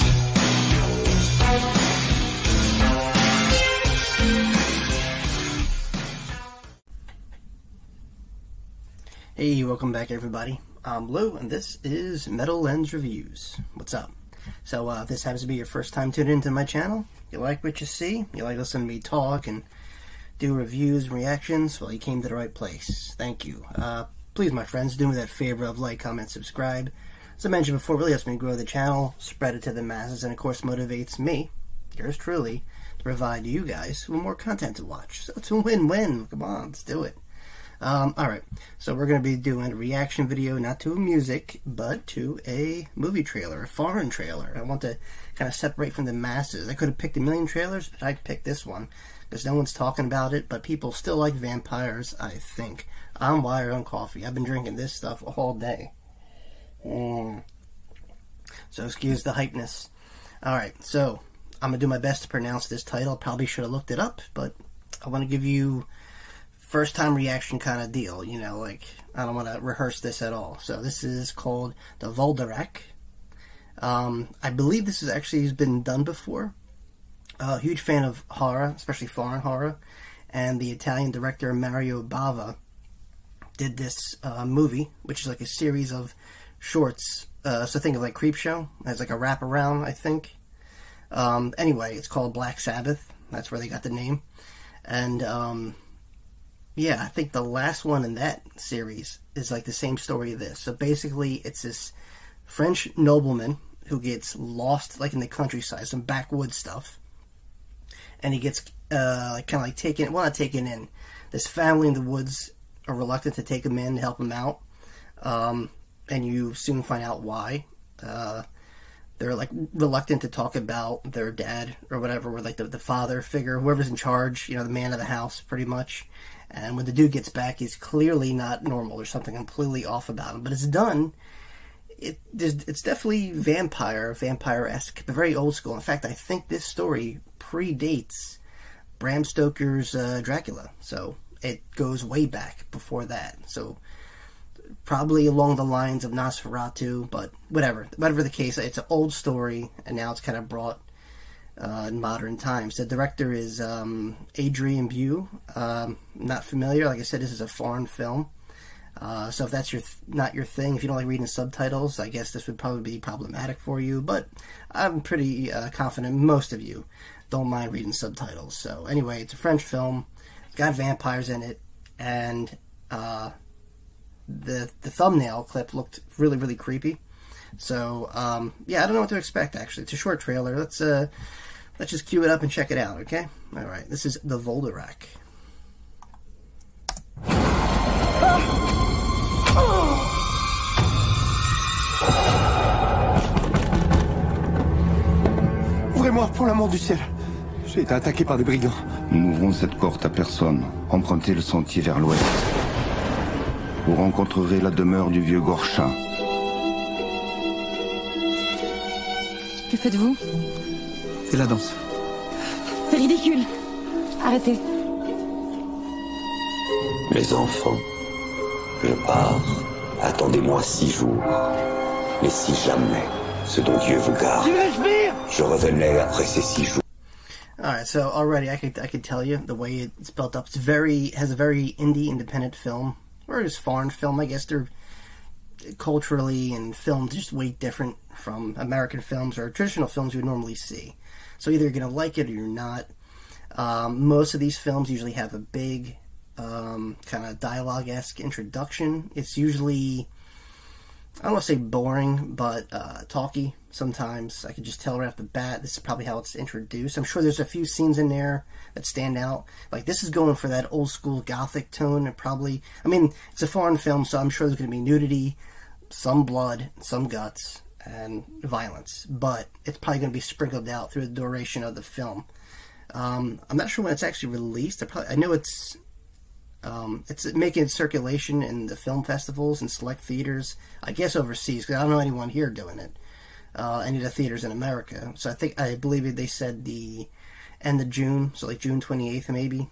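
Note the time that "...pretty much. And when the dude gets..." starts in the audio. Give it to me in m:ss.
2:05.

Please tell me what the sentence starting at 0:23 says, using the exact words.
Uh, please my friends, do me that favor of like, comment, subscribe.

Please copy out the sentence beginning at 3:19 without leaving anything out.
Nous n'ouvrons cette porte à personne.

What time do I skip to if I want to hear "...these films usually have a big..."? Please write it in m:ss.
4:04.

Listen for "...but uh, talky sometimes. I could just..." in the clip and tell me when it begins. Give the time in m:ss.
4:12.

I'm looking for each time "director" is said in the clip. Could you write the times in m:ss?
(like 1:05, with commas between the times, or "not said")
1:21, 2:32.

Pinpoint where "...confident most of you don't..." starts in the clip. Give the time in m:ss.
2:45.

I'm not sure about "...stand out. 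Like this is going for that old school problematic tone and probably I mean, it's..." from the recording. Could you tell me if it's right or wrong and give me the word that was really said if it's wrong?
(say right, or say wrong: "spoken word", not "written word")
wrong: "gothic", not "problematic".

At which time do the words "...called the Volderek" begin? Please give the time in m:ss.
1:11.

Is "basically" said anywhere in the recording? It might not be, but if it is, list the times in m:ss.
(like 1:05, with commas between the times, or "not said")
1:40.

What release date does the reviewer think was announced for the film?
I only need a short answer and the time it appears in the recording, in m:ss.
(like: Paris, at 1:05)
June 28th, at 4:48.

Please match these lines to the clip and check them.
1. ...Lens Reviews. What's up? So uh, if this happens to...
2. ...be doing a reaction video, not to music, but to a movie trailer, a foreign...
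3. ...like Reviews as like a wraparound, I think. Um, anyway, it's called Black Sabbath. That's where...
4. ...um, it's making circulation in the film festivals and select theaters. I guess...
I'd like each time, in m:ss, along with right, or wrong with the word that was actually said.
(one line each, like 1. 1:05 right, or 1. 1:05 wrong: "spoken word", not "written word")
1. 0:12 right
2. 0:39 right
3. 1:28 wrong: "Creepshow", not "Reviews"
4. 4:36 right.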